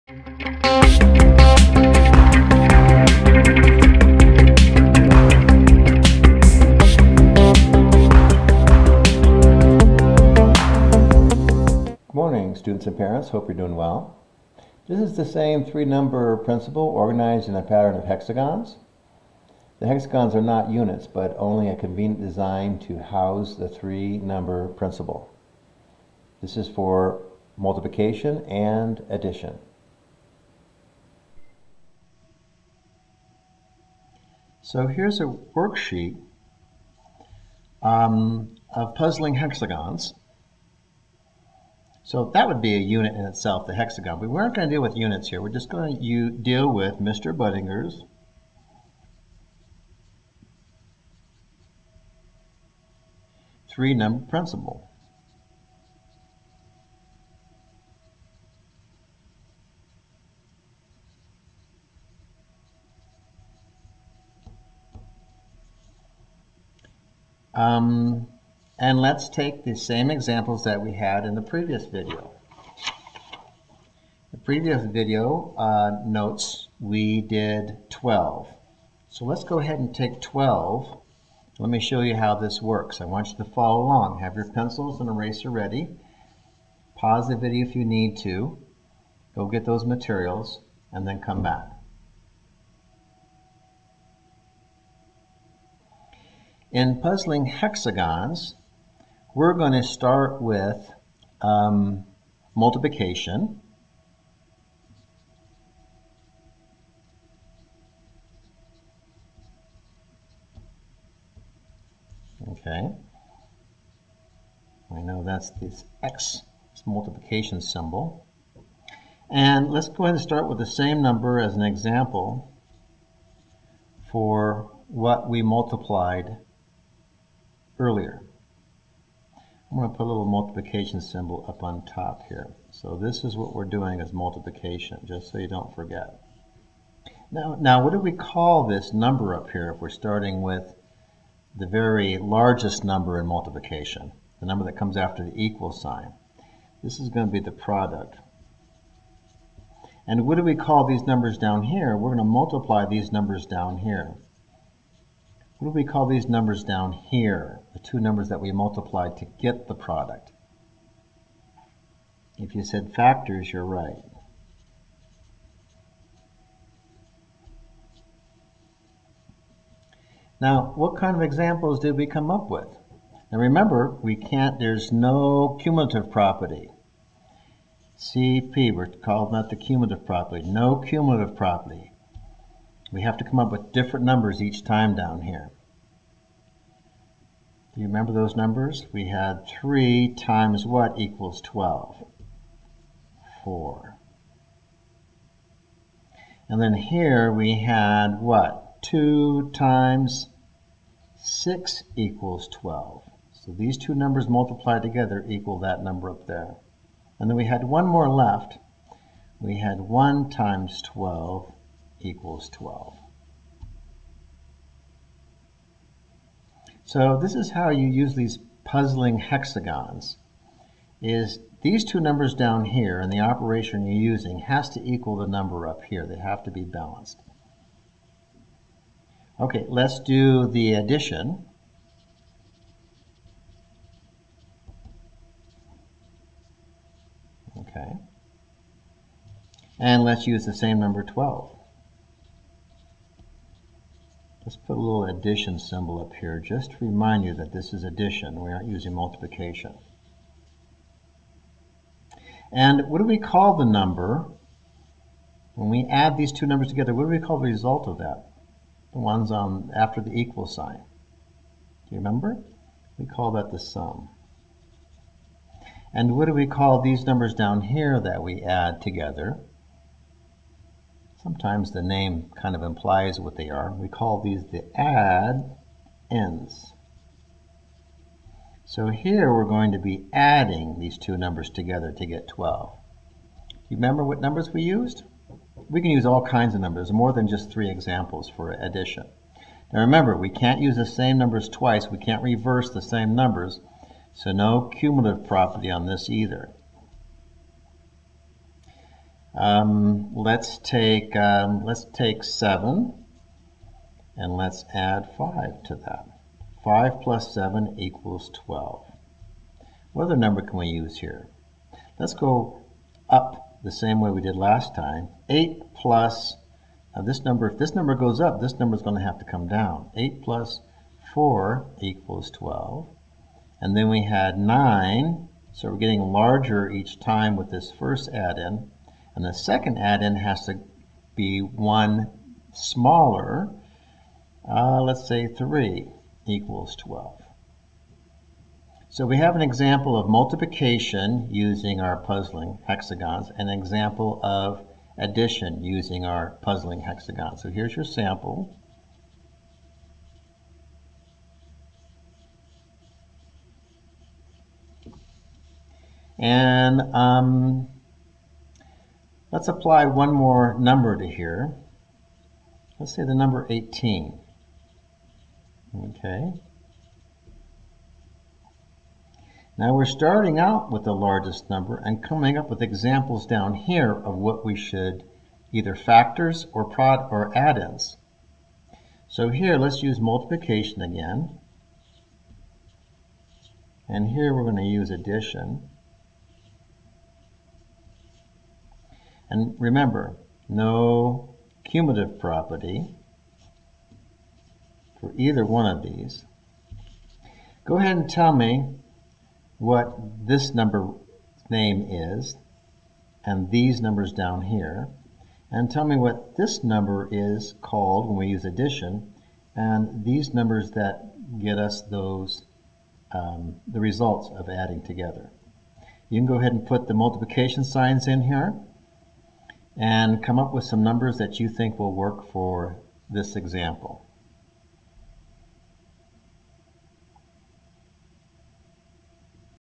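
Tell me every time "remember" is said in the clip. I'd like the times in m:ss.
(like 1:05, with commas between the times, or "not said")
2:53, 3:07, 4:21, 4:43, 4:49, 6:29.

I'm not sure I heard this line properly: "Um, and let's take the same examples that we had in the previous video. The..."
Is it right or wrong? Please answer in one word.
right.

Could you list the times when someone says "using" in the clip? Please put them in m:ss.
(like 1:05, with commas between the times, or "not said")
3:44, 4:08, 5:41, 5:45.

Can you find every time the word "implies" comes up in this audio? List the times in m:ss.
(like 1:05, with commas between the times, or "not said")
4:32.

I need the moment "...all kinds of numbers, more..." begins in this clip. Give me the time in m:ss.
4:46.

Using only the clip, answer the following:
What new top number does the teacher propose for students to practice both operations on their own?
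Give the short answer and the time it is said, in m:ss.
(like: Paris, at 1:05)
18, at 6:03.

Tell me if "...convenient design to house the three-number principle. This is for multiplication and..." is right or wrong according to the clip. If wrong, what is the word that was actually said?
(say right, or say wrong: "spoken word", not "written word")
right.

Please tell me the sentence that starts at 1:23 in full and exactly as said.
I want you to follow along.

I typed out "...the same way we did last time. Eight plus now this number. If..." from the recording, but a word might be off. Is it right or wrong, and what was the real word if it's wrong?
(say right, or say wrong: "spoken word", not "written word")
right.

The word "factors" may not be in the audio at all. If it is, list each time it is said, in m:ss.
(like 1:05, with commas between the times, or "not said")
2:42, 6:15.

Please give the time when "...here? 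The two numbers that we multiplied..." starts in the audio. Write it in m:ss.
2:36.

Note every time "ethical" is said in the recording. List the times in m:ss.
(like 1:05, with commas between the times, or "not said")
not said.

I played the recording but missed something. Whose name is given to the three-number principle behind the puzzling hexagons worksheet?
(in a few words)
Mr. Budinger.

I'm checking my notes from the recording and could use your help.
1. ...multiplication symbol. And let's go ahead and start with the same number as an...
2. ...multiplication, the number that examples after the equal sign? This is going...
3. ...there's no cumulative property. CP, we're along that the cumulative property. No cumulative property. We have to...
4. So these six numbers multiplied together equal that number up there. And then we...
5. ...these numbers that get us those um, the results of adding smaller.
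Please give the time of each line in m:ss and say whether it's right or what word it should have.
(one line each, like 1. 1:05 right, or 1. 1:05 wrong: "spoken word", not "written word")
1. 1:56 right
2. 2:23 wrong: "comes", not "examples"
3. 2:54 wrong: "calling", not "along"
4. 3:23 wrong: "two", not "six"
5. 6:50 wrong: "together", not "smaller".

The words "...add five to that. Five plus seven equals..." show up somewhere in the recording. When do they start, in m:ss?
5:04.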